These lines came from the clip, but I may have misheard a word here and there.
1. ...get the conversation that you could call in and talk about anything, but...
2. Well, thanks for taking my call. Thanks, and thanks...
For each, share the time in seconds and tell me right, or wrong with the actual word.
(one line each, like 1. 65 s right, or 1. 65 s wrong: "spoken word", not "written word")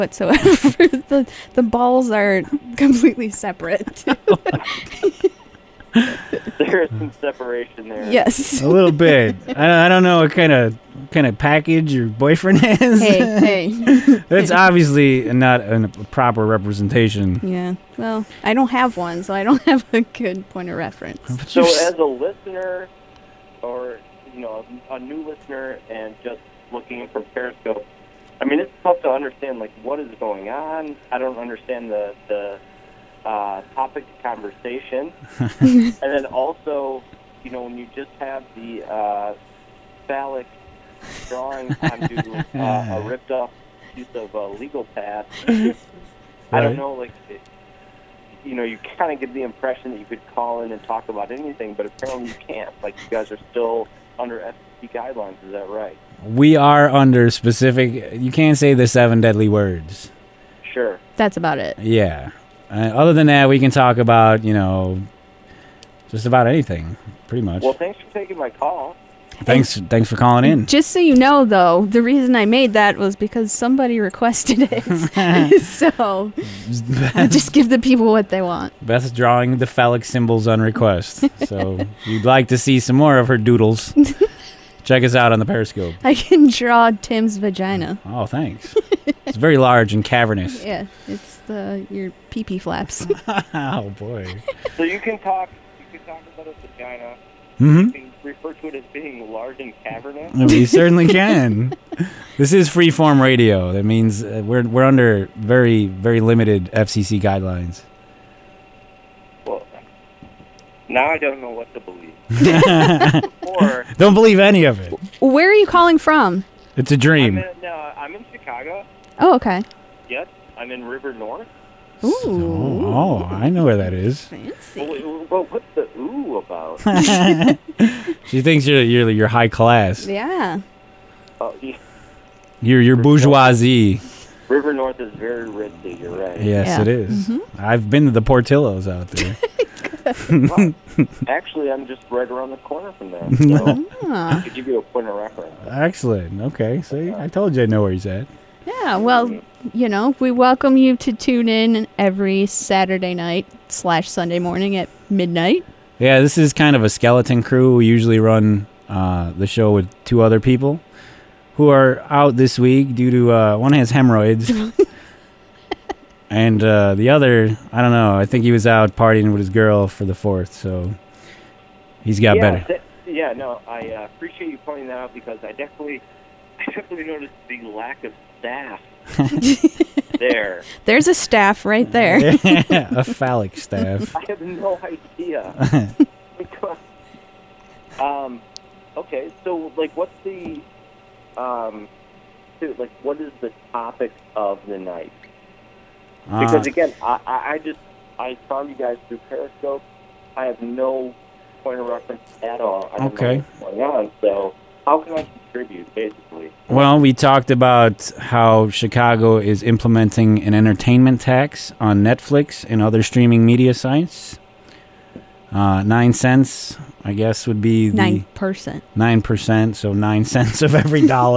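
1. 49 s wrong: "impression", not "conversation"
2. 67 s right.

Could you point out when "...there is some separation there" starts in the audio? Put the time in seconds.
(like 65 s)
5 s.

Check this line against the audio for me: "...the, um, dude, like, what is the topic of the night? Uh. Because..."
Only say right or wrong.
right.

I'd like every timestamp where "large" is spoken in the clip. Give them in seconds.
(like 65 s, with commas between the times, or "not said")
89 s, 99 s.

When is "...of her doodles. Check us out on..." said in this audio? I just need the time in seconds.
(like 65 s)
83 s.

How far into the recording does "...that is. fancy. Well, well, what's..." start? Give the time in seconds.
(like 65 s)
123 s.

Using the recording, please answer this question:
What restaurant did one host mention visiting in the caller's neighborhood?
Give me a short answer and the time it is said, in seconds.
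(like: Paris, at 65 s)
Portillos, at 138 s.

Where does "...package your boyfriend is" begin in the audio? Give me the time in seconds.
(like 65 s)
11 s.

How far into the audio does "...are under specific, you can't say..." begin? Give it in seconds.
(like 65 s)
56 s.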